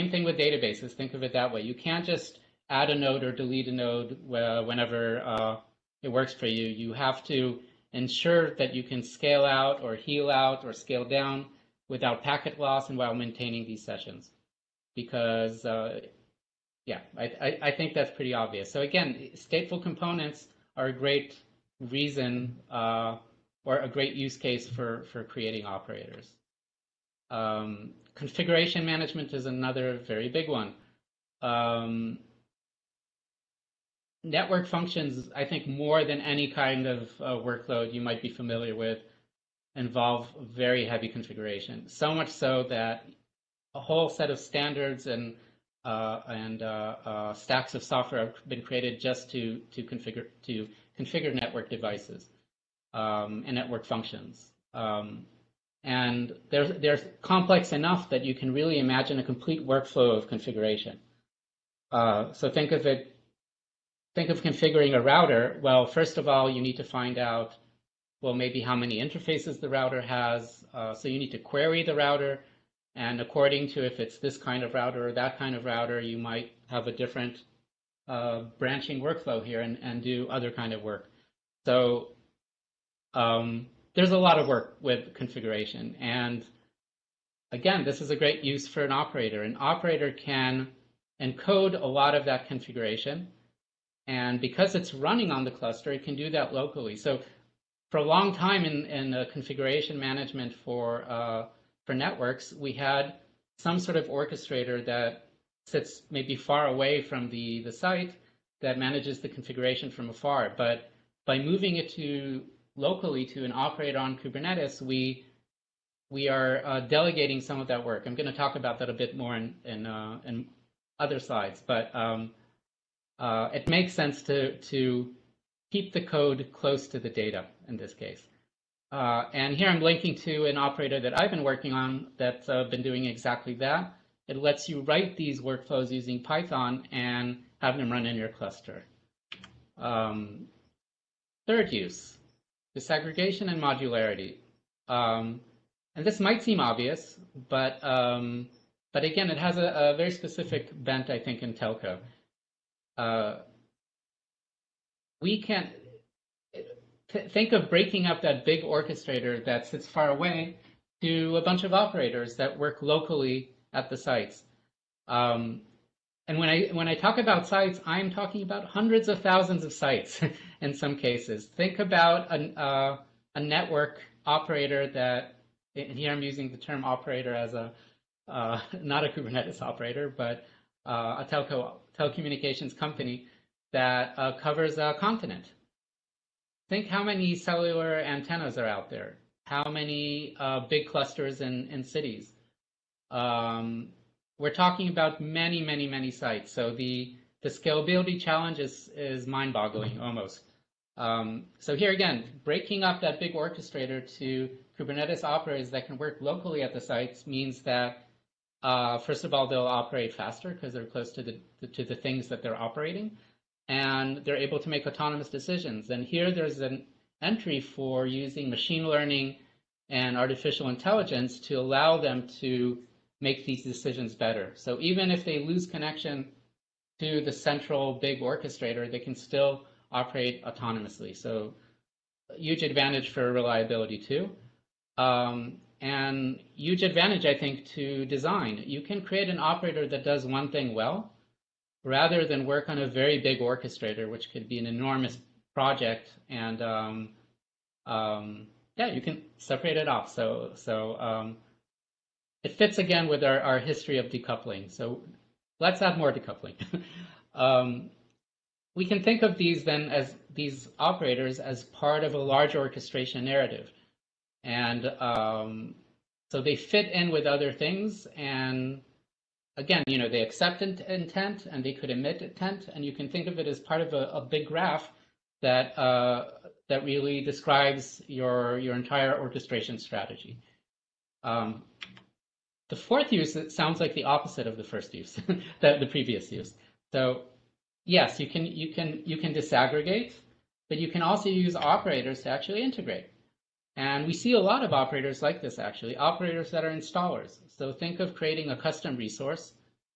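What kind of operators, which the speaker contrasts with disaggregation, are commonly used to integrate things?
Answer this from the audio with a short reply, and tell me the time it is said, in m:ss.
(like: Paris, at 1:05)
installers, at 4:56.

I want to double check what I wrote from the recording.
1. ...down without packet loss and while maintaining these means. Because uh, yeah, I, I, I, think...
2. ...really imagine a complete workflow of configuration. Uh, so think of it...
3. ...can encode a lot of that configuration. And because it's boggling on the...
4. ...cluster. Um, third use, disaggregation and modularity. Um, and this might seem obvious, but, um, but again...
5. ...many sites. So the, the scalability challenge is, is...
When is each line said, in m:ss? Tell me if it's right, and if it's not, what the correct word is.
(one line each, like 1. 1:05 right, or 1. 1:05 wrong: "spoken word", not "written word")
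1. 0:11 wrong: "sessions", not "means"
2. 0:58 right
3. 1:30 wrong: "running", not "boggling"
4. 2:18 right
5. 3:15 right.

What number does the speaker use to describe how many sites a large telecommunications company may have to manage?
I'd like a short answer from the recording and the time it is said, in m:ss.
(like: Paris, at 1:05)
hundreds of thousands, at 2:48.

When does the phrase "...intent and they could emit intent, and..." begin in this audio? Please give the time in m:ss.
4:30.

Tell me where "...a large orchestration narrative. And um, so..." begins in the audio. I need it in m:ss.
4:22.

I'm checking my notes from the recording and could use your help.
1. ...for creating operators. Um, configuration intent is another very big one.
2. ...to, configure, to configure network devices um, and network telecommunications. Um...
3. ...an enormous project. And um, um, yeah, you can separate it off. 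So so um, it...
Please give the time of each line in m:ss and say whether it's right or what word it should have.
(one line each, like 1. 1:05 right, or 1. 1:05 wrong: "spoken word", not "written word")
1. 0:25 wrong: "management", not "intent"
2. 0:49 wrong: "functions", not "telecommunications"
3. 4:04 right.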